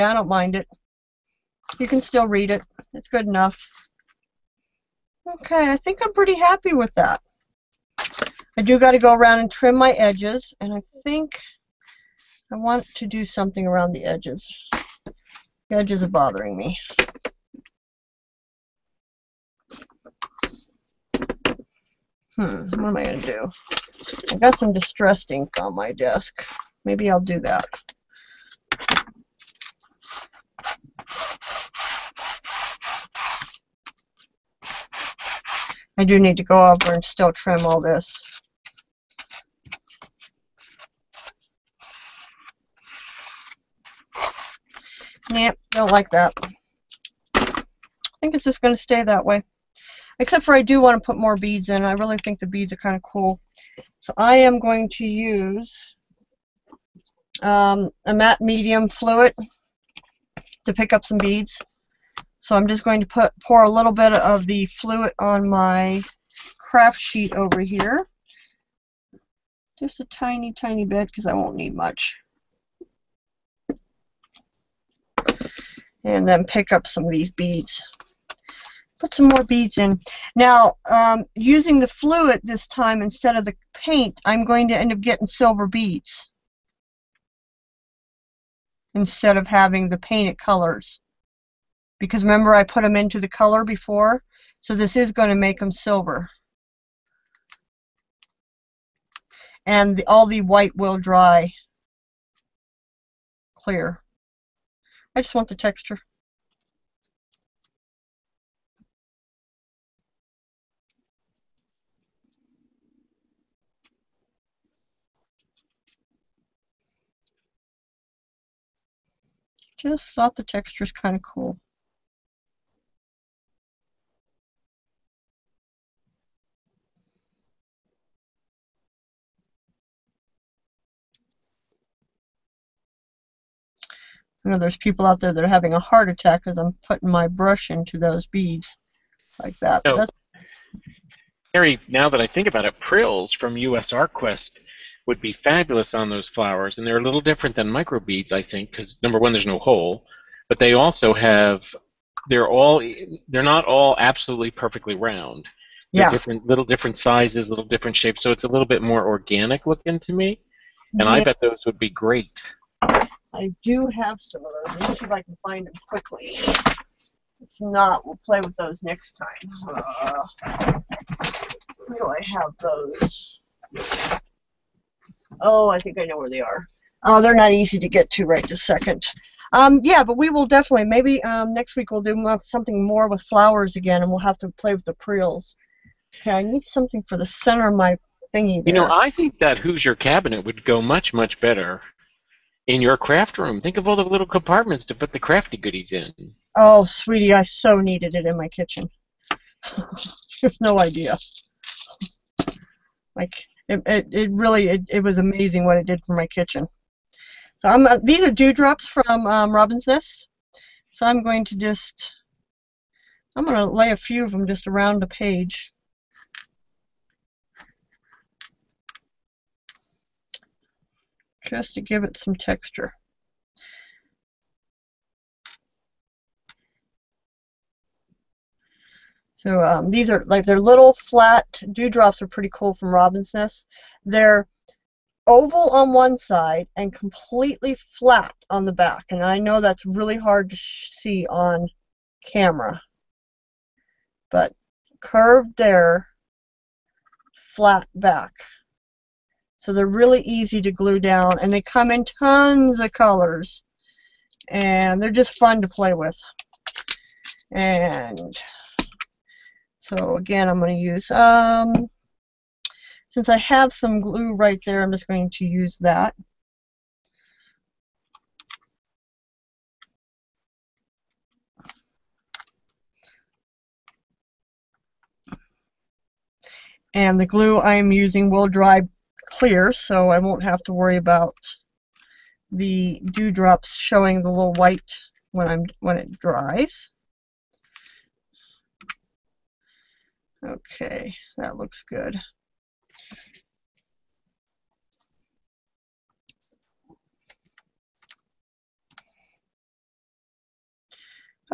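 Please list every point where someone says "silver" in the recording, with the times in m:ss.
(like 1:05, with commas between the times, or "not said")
1:25, 1:35.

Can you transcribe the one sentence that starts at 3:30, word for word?
So I'm going to just I'm going to lay a few of them just around the page.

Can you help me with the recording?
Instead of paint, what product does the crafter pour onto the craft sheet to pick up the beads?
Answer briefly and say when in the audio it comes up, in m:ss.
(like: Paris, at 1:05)
Matte medium fluid, at 0:58.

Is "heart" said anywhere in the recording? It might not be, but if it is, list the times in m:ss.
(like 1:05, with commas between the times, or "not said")
2:15.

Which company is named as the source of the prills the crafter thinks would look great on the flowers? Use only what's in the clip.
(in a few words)
US ArtQuest.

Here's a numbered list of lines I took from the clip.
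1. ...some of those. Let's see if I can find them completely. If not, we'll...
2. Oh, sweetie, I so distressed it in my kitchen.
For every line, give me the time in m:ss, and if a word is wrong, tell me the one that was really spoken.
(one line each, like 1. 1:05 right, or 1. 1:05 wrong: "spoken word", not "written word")
1. 2:44 wrong: "quickly", not "completely"
2. 3:16 wrong: "needed", not "distressed".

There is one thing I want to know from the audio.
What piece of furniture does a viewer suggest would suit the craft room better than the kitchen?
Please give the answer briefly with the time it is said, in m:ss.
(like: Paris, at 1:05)
Hoosier cabinet, at 3:09.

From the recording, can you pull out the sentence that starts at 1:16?
And then pick up some of these beads.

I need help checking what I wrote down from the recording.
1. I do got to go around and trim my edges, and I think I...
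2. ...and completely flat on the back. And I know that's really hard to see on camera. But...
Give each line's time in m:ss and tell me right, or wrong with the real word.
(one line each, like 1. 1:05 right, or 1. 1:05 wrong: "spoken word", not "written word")
1. 0:08 right
2. 3:56 right.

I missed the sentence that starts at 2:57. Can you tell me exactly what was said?
Oh, they're not easy to get to right this second.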